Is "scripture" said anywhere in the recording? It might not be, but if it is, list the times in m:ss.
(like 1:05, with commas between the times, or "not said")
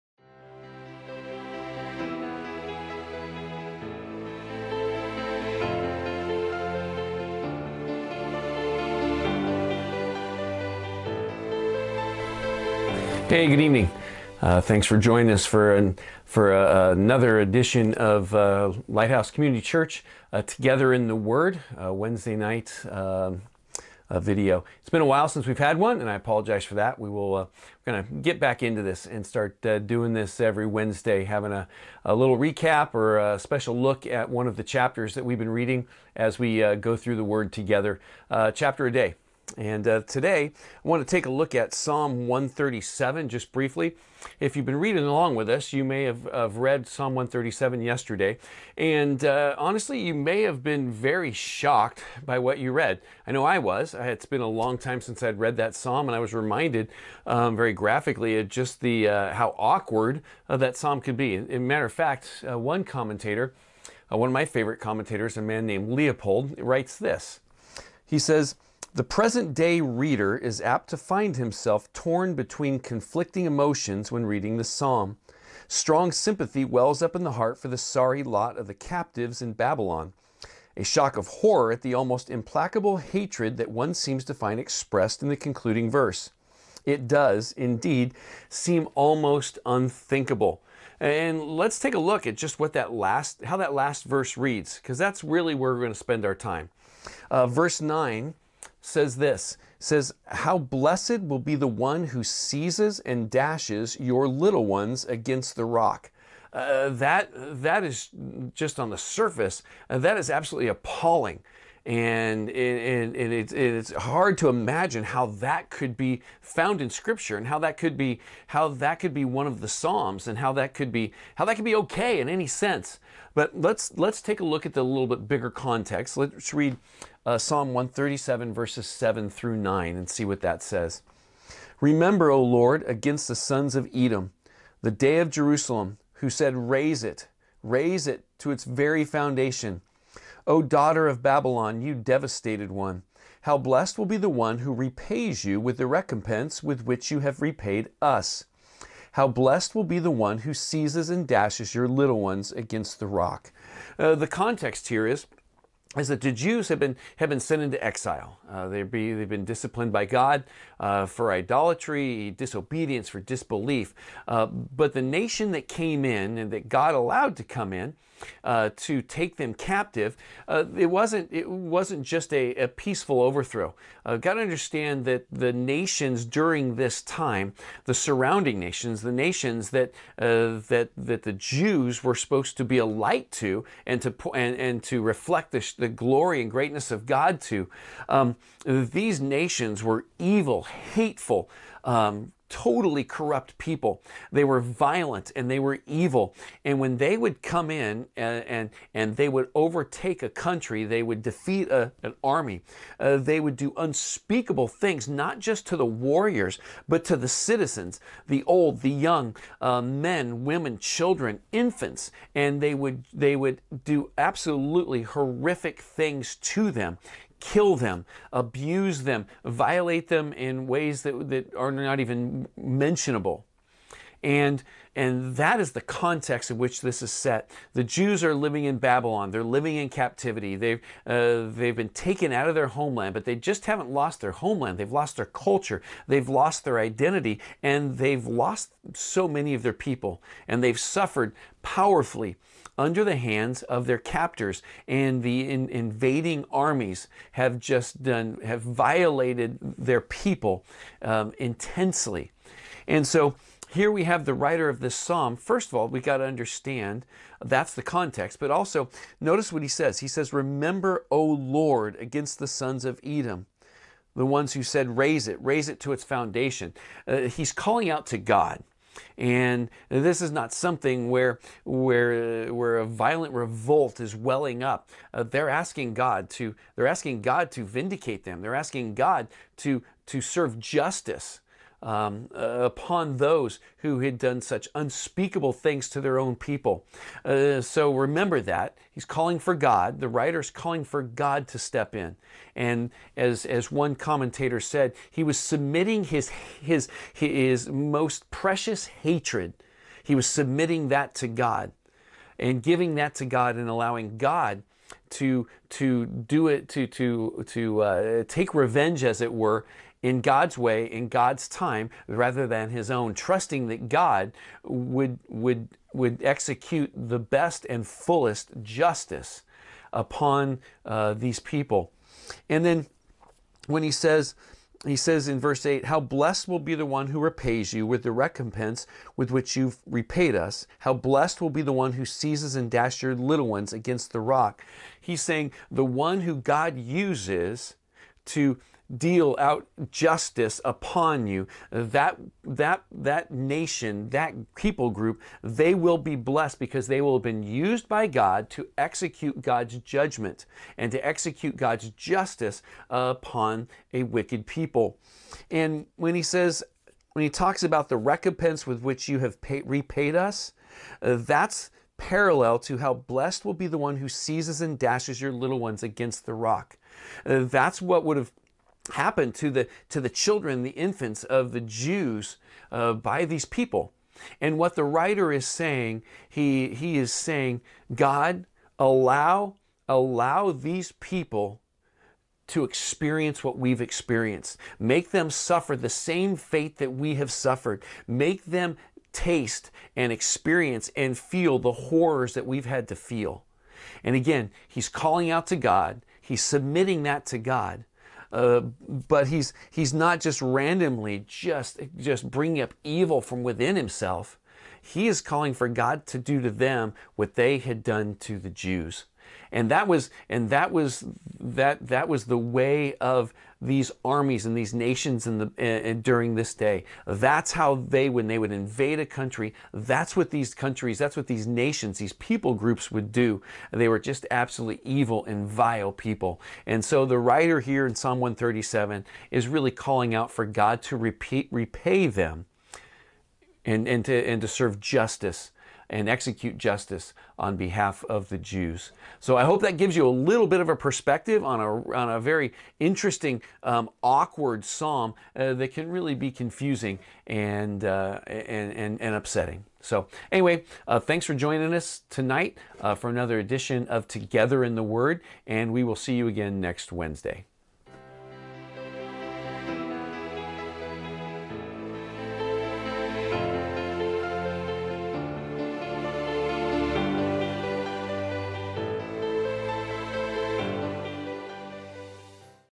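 1:56.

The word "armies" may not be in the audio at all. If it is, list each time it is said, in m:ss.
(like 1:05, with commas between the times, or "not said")
4:06, 6:54.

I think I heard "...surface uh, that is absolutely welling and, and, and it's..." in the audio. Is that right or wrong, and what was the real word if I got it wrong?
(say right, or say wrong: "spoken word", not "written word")
wrong: "appalling", not "welling".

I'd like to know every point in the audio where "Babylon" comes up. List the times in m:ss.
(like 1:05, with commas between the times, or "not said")
1:19, 2:21, 3:48.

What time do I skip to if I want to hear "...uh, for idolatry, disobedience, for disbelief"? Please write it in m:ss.
2:40.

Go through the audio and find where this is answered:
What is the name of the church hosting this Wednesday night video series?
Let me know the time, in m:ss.
0:18.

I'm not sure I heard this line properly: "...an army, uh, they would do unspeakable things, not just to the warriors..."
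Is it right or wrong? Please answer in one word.
right.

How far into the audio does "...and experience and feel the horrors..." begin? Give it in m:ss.
6:29.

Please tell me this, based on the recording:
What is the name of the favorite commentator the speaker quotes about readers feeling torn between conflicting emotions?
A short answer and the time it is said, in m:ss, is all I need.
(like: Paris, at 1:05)
Leupold, at 1:05.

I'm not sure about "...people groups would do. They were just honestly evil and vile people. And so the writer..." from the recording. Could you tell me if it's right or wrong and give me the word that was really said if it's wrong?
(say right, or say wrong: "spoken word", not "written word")
wrong: "absolutely", not "honestly".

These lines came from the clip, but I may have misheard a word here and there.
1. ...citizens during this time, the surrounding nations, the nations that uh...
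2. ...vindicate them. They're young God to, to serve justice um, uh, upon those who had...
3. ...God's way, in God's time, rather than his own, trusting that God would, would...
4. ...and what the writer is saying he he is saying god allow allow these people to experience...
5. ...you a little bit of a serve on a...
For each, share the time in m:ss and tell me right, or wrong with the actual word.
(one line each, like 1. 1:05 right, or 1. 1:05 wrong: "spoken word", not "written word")
1. 2:55 wrong: "nations", not "citizens"
2. 4:37 wrong: "asking", not "young"
3. 5:10 right
4. 6:14 right
5. 7:19 wrong: "perspective", not "serve".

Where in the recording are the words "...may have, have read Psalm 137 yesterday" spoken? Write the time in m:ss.
0:45.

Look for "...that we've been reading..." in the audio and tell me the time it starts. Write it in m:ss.
0:35.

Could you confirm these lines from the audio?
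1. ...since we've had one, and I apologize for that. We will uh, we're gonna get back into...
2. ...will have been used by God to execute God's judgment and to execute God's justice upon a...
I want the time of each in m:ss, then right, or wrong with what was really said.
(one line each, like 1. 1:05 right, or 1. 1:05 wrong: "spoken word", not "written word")
1. 0:25 right
2. 5:47 right.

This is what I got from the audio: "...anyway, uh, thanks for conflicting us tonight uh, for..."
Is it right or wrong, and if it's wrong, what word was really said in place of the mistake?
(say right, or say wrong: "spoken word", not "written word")
wrong: "joining", not "conflicting".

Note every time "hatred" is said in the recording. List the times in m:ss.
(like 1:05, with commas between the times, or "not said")
1:22, 4:58.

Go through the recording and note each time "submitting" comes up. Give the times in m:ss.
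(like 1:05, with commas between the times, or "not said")
4:55, 5:00, 6:36.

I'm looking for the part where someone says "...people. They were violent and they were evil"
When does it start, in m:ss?
3:13.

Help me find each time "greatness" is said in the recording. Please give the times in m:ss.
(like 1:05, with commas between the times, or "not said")
3:06.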